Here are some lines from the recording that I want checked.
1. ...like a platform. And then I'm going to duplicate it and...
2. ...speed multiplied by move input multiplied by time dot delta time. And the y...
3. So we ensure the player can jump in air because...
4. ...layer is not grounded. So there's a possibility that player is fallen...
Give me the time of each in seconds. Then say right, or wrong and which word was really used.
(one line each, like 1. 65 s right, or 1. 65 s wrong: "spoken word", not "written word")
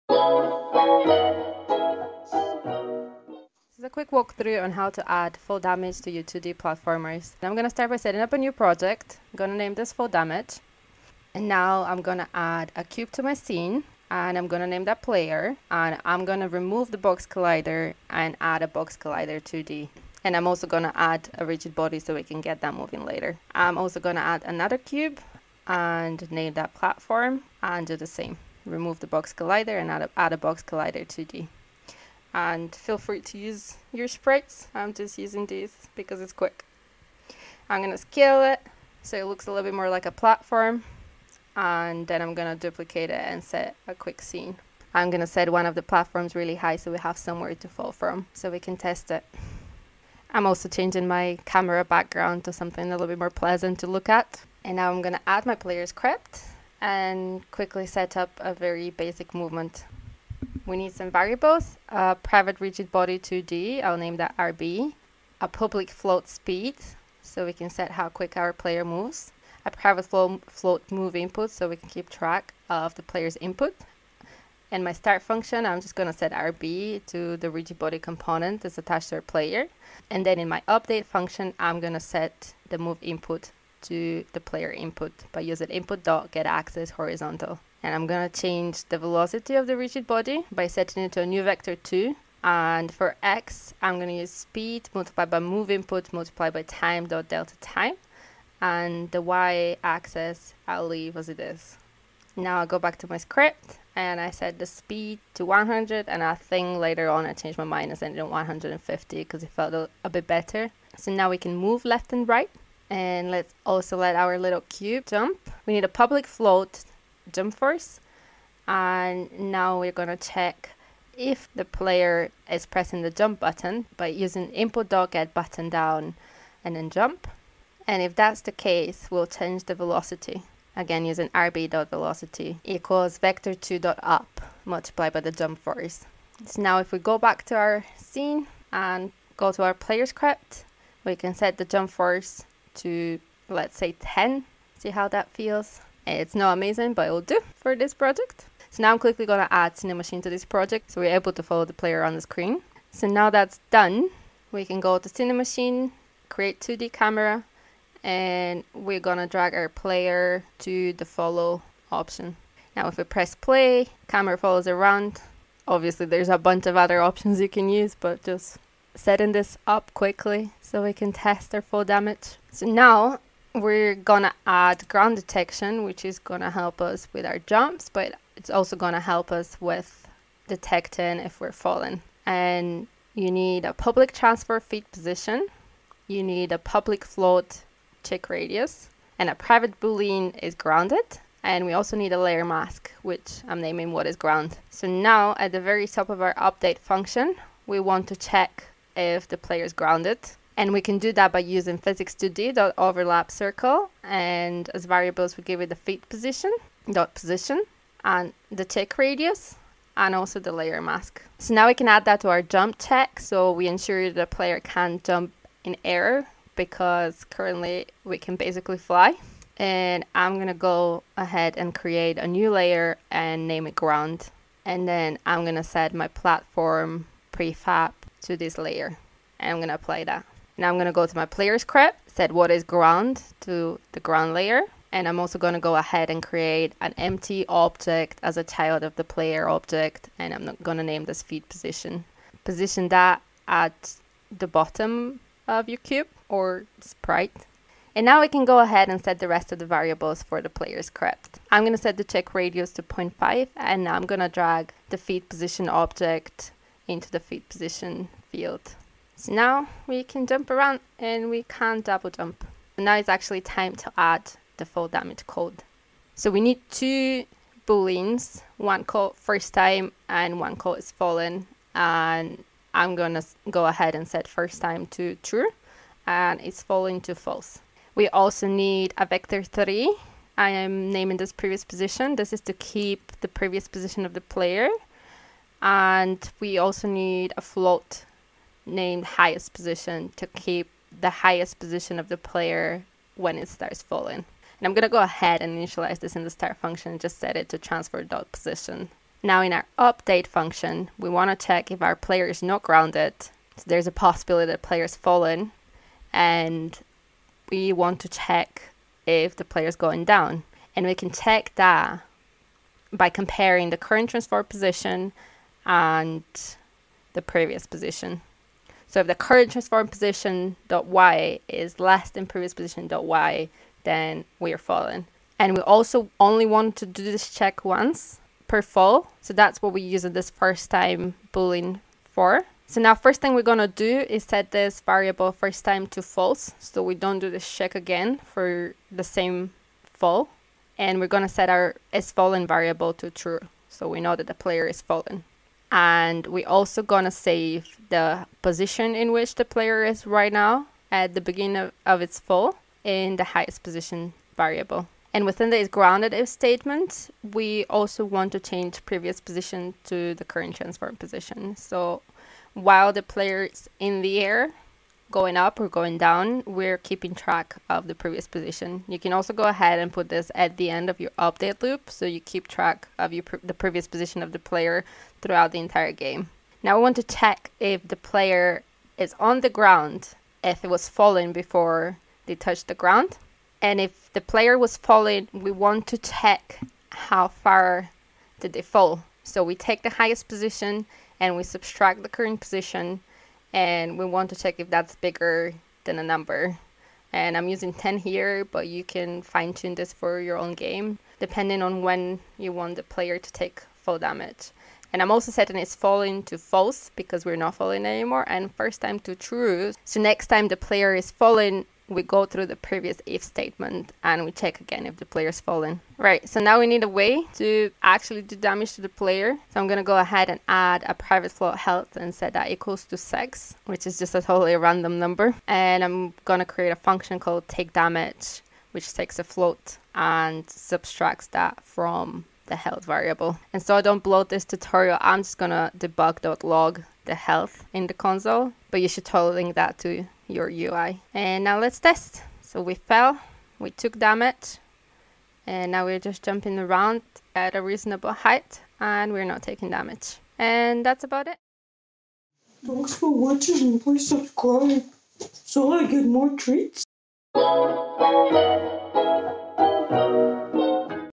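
1. 39 s right
2. 94 s right
3. 213 s right
4. 301 s wrong: "player", not "layer".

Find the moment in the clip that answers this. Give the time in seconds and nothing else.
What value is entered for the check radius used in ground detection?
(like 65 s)
252 s.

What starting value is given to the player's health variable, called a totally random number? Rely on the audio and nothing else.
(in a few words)
6.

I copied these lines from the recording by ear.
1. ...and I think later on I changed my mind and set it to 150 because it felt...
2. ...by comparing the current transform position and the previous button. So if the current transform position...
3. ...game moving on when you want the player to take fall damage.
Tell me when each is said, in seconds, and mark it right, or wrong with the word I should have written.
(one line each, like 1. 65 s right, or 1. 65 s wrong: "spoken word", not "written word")
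1. 106 s right
2. 312 s wrong: "position", not "button"
3. 400 s wrong: "depending", not "moving".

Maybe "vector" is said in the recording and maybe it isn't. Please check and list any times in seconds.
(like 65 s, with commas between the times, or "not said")
91 s, 133 s, 279 s.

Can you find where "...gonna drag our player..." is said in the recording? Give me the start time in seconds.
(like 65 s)
159 s.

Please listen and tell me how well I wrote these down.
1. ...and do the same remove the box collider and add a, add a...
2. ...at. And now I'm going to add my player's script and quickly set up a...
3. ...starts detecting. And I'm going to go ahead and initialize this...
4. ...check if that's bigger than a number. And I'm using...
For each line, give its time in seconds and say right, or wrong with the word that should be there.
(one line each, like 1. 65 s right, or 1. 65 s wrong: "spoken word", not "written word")
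1. 27 s right
2. 54 s right
3. 293 s wrong: "falling", not "detecting"
4. 394 s right.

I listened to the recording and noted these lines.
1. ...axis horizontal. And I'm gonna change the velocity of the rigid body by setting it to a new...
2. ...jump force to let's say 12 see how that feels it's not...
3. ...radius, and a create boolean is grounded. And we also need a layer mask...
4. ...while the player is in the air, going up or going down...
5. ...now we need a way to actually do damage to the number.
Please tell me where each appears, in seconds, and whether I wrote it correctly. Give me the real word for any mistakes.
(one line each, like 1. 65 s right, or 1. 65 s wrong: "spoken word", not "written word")
1. 86 s right
2. 141 s wrong: "10", not "12"
3. 188 s wrong: "private", not "create"
4. 362 s right
5. 416 s wrong: "player", not "number".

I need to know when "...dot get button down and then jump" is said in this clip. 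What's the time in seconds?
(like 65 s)
124 s.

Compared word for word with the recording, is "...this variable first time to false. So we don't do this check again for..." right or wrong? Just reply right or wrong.
right.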